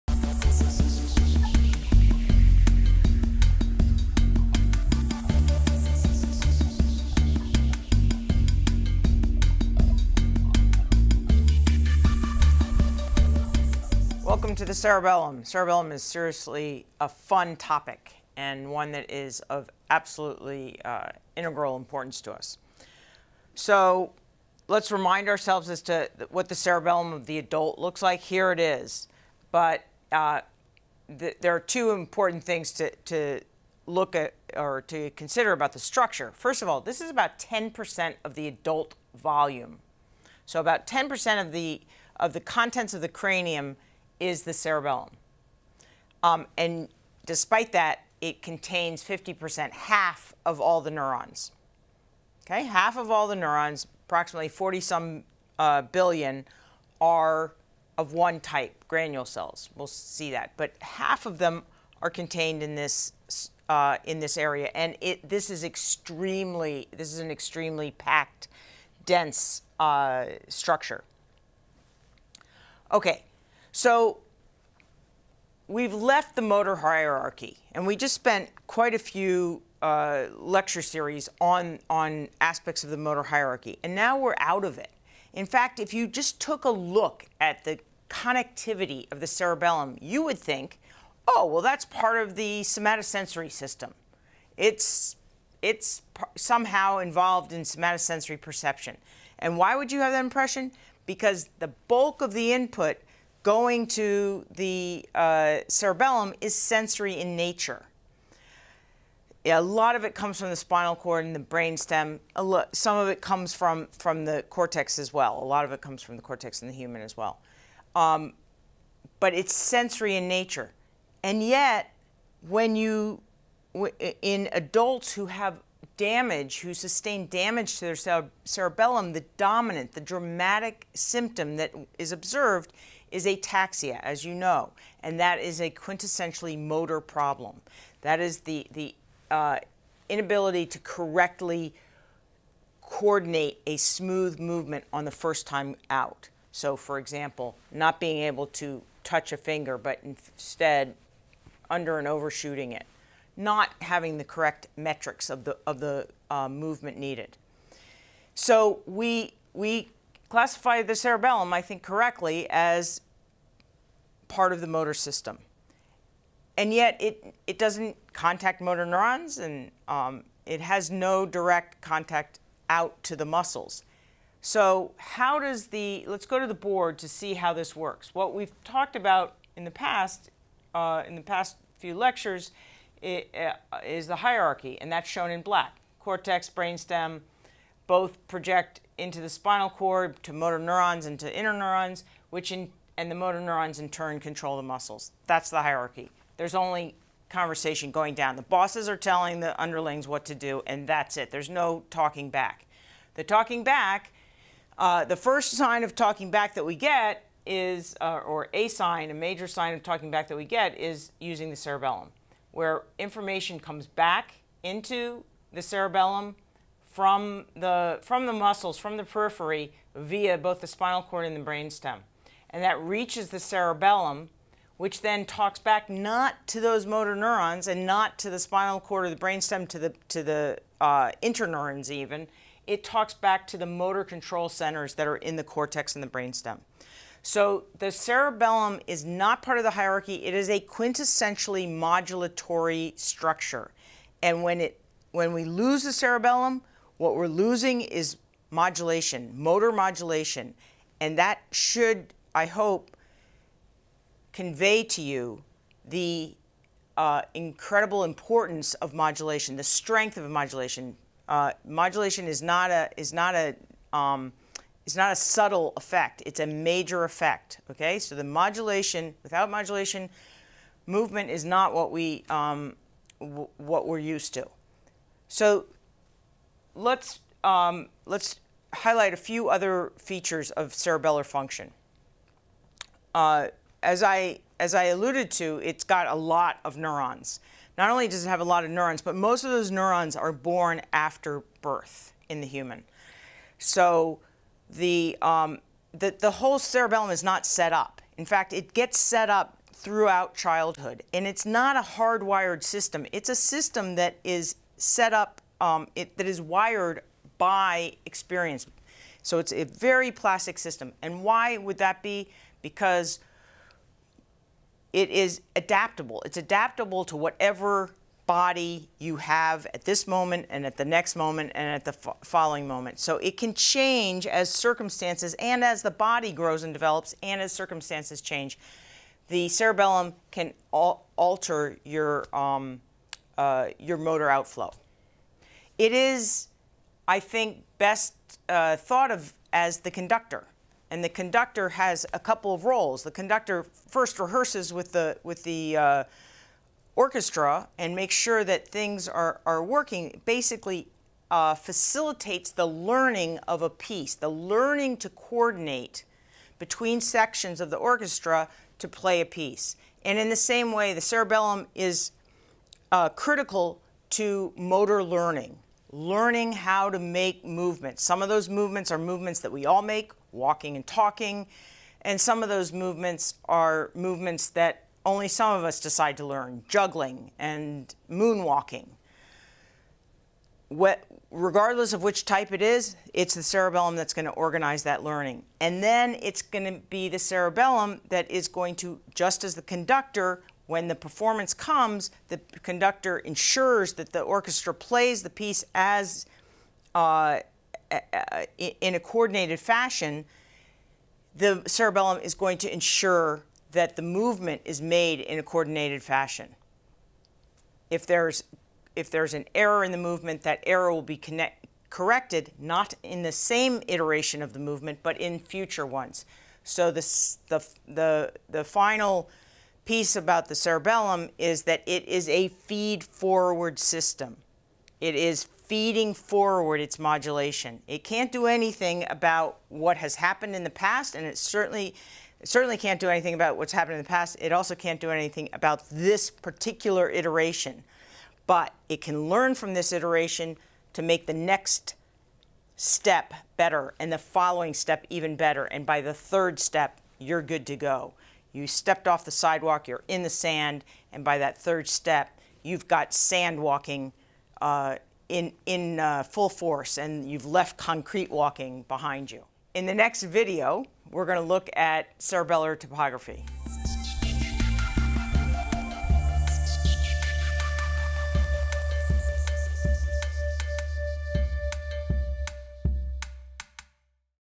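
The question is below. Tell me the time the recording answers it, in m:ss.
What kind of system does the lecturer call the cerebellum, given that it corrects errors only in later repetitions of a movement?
7:02.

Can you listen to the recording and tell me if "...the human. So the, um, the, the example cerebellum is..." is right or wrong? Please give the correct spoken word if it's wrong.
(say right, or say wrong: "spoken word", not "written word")
wrong: "whole", not "example".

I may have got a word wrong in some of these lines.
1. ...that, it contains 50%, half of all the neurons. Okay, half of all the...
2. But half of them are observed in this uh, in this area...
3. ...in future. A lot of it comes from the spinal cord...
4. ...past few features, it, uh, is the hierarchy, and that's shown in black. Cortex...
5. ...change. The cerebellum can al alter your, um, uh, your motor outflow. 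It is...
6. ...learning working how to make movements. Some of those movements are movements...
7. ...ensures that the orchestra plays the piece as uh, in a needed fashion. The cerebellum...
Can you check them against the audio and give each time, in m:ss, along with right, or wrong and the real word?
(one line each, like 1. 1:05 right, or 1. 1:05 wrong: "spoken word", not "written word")
1. 0:47 right
2. 1:00 wrong: "contained", not "observed"
3. 1:47 wrong: "nature", not "future"
4. 3:01 wrong: "lectures", not "features"
5. 5:28 right
6. 6:05 wrong: "learning", not "working"
7. 6:33 wrong: "coordinated", not "needed".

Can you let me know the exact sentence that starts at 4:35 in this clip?
So let's, um, let's highlight a few other features of cerebellar function.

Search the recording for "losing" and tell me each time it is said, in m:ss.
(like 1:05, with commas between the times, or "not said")
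4:07.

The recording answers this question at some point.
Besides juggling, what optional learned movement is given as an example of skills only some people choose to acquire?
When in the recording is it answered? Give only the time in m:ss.
6:18.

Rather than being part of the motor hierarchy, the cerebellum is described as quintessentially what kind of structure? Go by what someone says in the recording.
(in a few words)
modulatory.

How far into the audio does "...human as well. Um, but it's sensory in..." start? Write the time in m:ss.
1:56.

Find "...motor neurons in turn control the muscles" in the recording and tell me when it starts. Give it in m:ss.
3:13.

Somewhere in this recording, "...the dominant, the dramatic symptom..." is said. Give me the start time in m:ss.
2:09.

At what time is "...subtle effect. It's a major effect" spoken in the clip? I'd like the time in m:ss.
4:25.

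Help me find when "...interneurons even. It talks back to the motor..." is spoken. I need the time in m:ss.
3:51.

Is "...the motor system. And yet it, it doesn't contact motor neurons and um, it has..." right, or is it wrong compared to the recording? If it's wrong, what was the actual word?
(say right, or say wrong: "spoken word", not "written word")
right.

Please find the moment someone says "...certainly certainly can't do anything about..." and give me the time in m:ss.
7:11.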